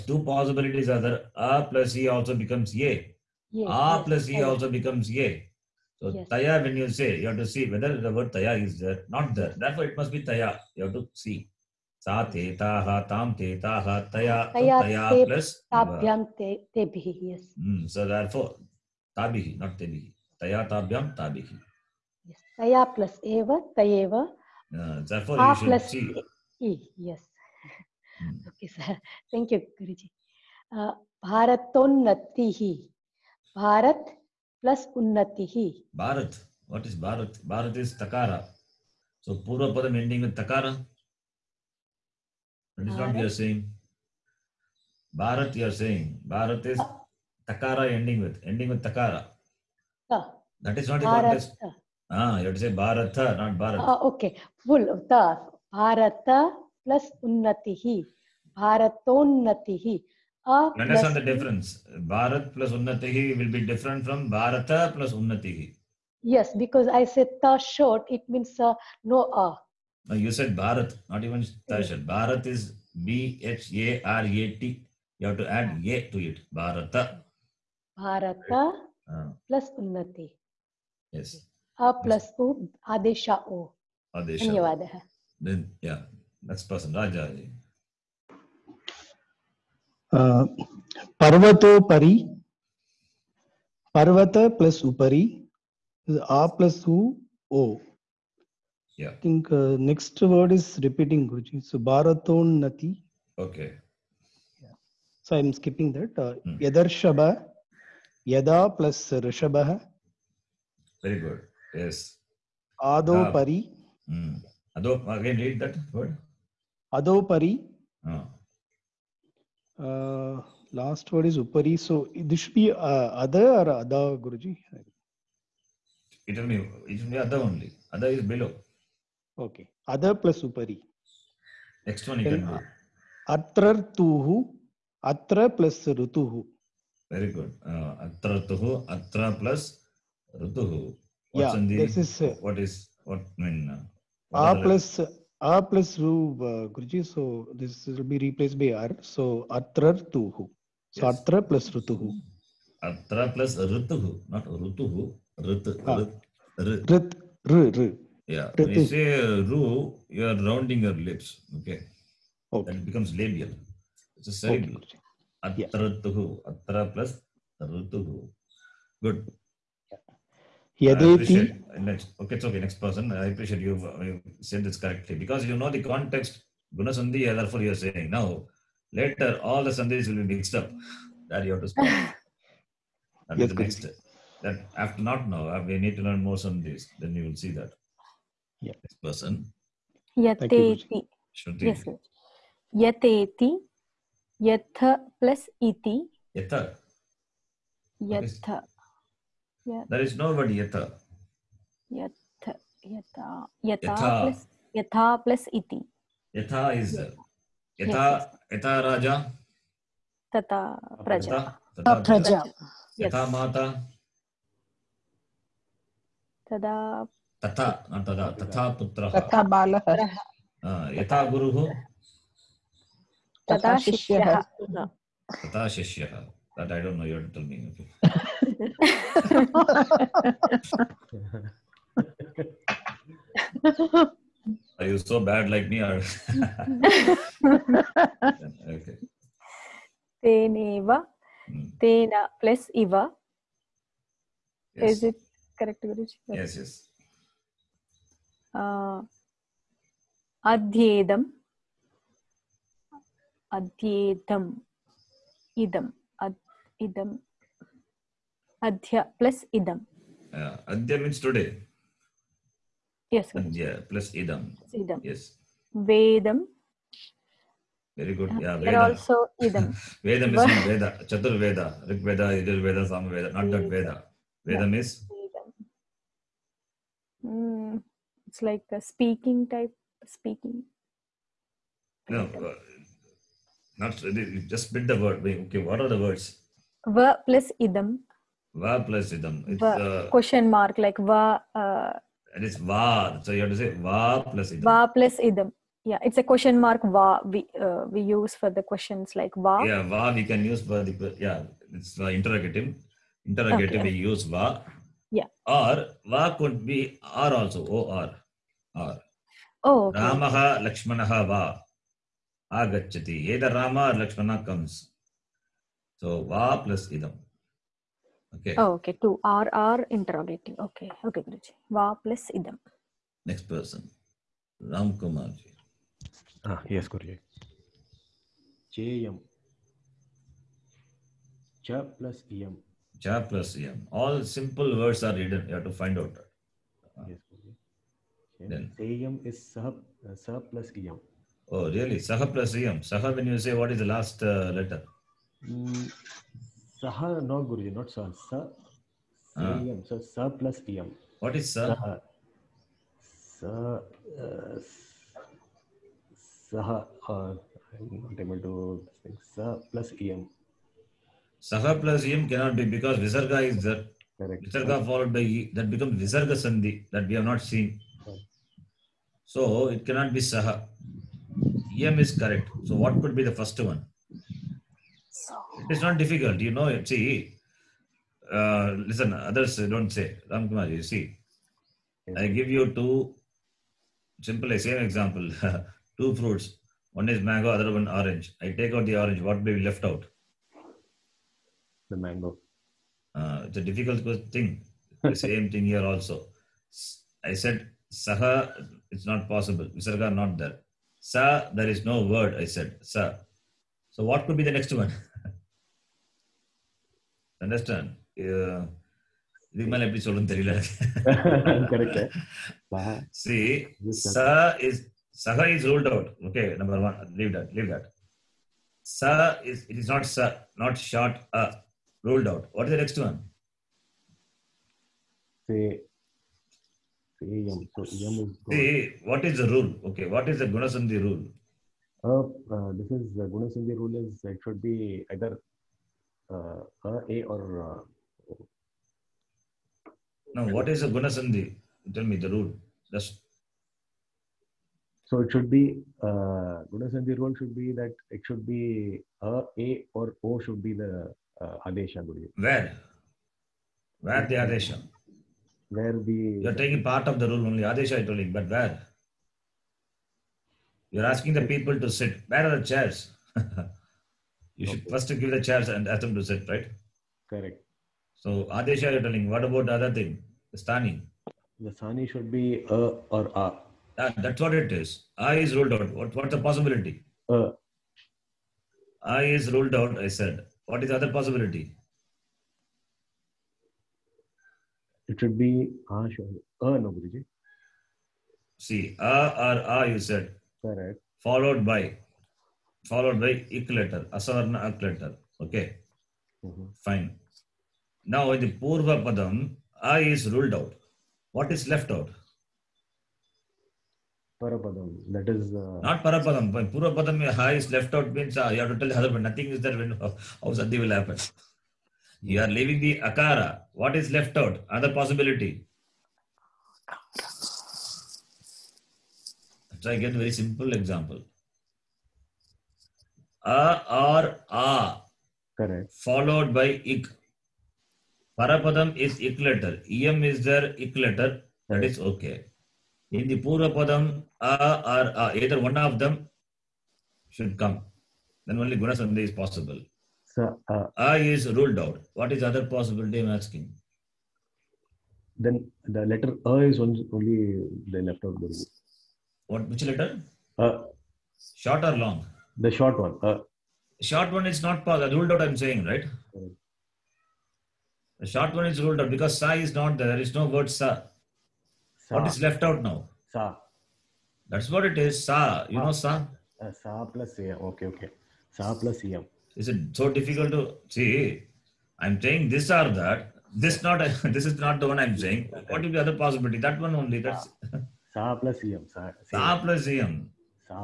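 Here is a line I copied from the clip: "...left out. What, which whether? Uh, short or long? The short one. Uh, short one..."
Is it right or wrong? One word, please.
wrong.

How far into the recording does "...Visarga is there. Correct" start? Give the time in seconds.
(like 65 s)
362 s.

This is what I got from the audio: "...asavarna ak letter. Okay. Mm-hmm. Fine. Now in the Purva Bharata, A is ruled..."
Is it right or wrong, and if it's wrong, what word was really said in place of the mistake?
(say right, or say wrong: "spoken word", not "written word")
wrong: "Padam", not "Bharata".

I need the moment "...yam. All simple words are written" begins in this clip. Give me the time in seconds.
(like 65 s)
333 s.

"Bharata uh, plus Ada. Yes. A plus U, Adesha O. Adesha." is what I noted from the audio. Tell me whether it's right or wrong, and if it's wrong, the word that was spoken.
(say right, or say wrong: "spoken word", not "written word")
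wrong: "Unnati", not "Ada".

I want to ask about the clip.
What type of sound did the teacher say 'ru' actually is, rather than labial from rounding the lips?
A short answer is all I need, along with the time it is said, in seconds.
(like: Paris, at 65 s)
cerebral, at 164 s.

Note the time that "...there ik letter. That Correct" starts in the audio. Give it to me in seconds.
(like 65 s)
530 s.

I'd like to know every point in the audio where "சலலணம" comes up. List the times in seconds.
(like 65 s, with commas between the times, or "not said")
410 s.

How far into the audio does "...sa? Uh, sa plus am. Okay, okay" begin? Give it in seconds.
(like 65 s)
565 s.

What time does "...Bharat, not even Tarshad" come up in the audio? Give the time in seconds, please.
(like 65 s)
70 s.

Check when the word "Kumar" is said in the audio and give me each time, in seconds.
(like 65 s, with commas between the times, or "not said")
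324 s, 380 s.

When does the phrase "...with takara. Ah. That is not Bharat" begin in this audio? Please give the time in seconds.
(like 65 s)
48 s.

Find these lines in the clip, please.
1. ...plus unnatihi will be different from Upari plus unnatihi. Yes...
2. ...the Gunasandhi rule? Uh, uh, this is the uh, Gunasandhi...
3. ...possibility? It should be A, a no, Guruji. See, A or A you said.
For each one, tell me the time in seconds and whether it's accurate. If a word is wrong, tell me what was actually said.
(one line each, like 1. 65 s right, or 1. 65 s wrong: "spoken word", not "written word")
1. 62 s wrong: "Bharata", not "Upari"
2. 430 s right
3. 481 s right.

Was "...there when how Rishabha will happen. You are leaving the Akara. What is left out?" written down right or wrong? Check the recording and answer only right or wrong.
wrong.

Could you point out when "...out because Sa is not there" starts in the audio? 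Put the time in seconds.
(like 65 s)
559 s.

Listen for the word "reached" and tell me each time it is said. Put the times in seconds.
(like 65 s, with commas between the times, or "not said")
not said.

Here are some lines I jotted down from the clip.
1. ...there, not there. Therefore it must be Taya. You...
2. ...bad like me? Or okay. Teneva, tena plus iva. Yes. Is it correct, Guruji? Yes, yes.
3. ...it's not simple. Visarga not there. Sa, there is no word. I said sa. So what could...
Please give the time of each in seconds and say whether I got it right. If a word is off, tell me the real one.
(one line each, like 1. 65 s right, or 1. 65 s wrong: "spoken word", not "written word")
1. 8 s right
2. 235 s right
3. 398 s wrong: "possible", not "simple".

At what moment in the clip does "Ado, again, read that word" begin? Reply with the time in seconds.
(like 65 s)
114 s.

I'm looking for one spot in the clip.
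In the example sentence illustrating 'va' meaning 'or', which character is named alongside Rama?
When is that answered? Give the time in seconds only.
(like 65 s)
309 s.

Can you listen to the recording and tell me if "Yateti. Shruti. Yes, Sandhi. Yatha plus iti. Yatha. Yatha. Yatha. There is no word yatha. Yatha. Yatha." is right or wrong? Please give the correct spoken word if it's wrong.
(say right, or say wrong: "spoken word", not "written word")
wrong: "Yateti", not "Sandhi".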